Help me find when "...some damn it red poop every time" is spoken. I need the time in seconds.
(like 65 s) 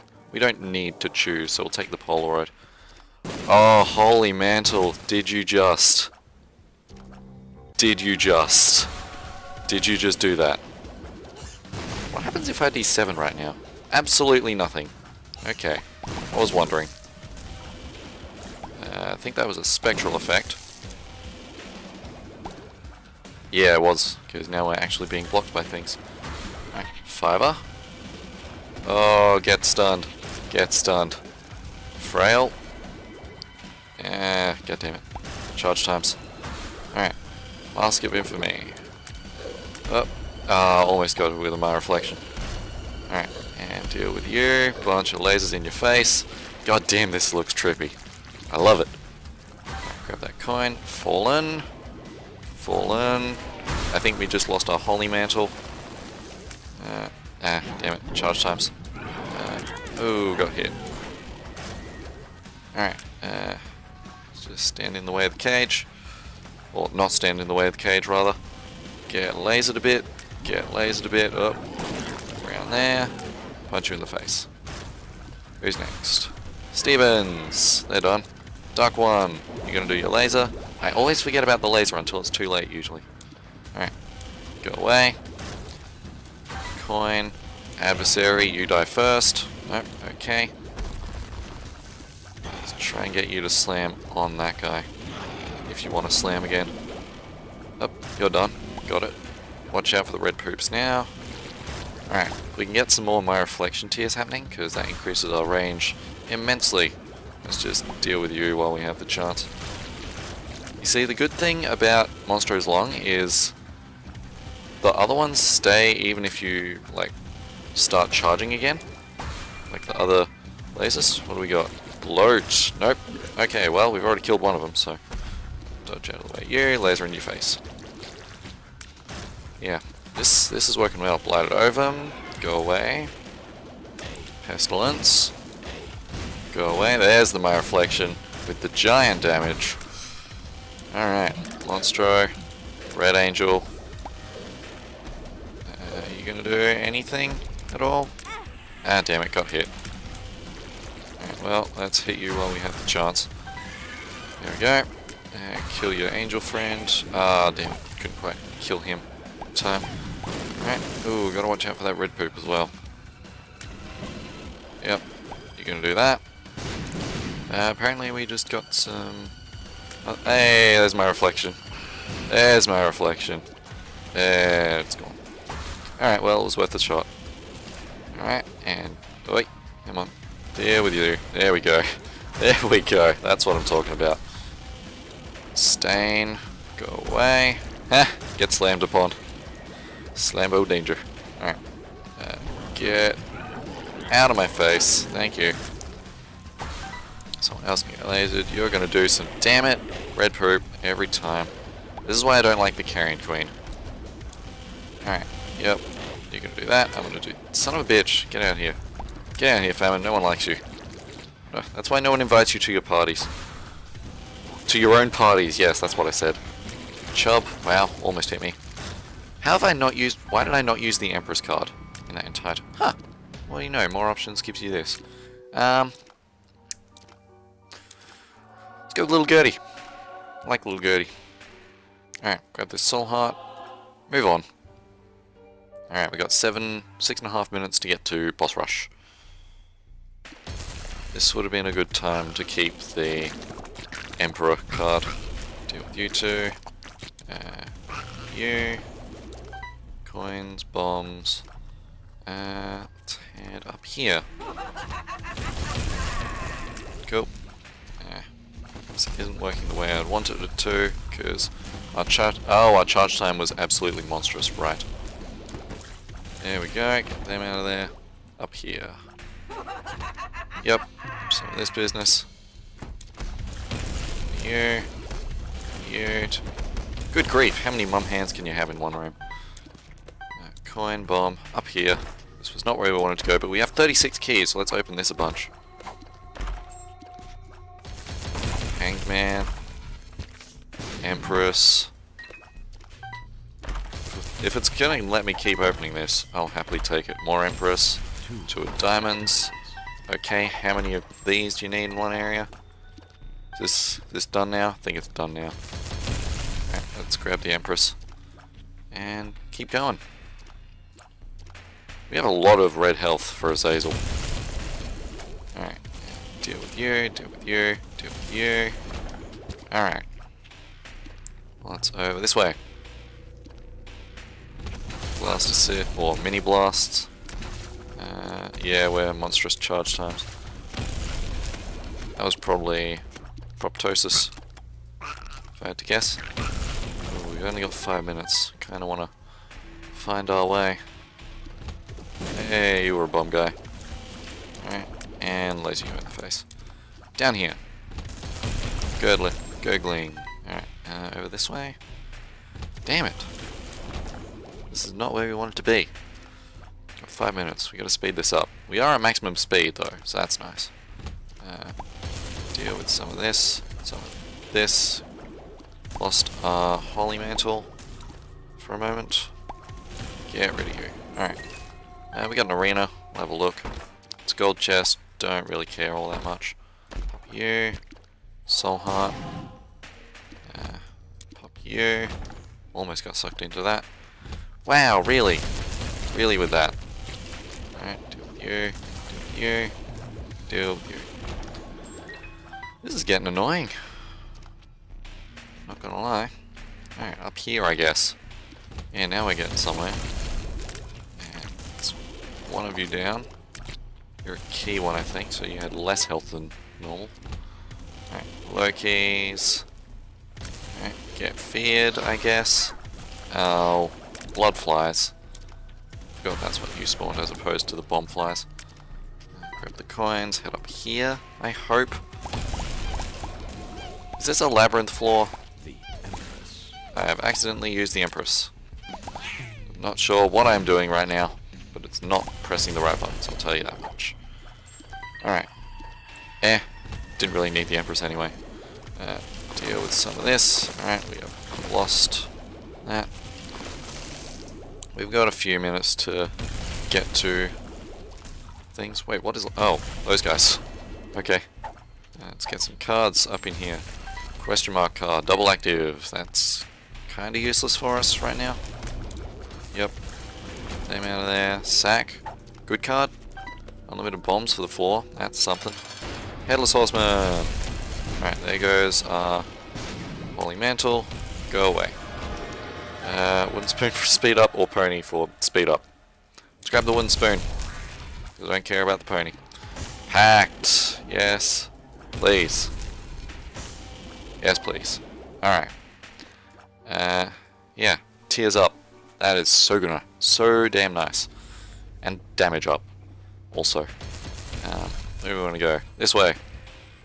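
199 s.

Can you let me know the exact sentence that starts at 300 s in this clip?
Okay, how many of these do you need in one area?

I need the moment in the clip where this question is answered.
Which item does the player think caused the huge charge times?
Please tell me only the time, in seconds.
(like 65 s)
333 s.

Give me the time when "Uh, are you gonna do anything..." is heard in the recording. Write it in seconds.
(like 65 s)
145 s.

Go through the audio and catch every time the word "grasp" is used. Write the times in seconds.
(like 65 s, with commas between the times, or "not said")
not said.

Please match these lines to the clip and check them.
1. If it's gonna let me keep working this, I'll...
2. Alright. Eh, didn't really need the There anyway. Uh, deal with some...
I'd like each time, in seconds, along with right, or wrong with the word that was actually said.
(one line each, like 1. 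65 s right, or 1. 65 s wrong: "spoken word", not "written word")
1. 294 s wrong: "opening", not "working"
2. 435 s wrong: "Empress", not "There".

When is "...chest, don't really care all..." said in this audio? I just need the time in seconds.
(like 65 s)
374 s.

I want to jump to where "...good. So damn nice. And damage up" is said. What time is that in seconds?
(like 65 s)
489 s.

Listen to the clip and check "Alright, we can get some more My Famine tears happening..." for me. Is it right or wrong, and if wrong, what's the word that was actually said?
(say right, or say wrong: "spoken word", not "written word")
wrong: "Reflection", not "Famine".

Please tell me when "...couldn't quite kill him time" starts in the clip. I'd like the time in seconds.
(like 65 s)
157 s.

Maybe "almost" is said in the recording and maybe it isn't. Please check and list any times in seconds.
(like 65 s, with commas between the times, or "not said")
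40 s, 218 s, 382 s.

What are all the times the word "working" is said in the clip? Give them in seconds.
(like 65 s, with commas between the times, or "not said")
130 s, 259 s.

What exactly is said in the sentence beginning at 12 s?
What happens if I D7 right now?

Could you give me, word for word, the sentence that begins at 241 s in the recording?
This would have been a good time to keep the Emperor card.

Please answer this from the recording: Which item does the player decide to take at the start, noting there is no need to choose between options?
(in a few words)
Polaroid.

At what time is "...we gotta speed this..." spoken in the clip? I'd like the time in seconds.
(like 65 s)
357 s.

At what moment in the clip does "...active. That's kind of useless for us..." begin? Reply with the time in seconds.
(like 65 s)
455 s.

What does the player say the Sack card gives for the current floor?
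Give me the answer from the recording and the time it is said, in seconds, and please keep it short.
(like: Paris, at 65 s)
Unlimited bombs, at 463 s.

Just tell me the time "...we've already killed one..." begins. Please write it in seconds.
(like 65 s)
123 s.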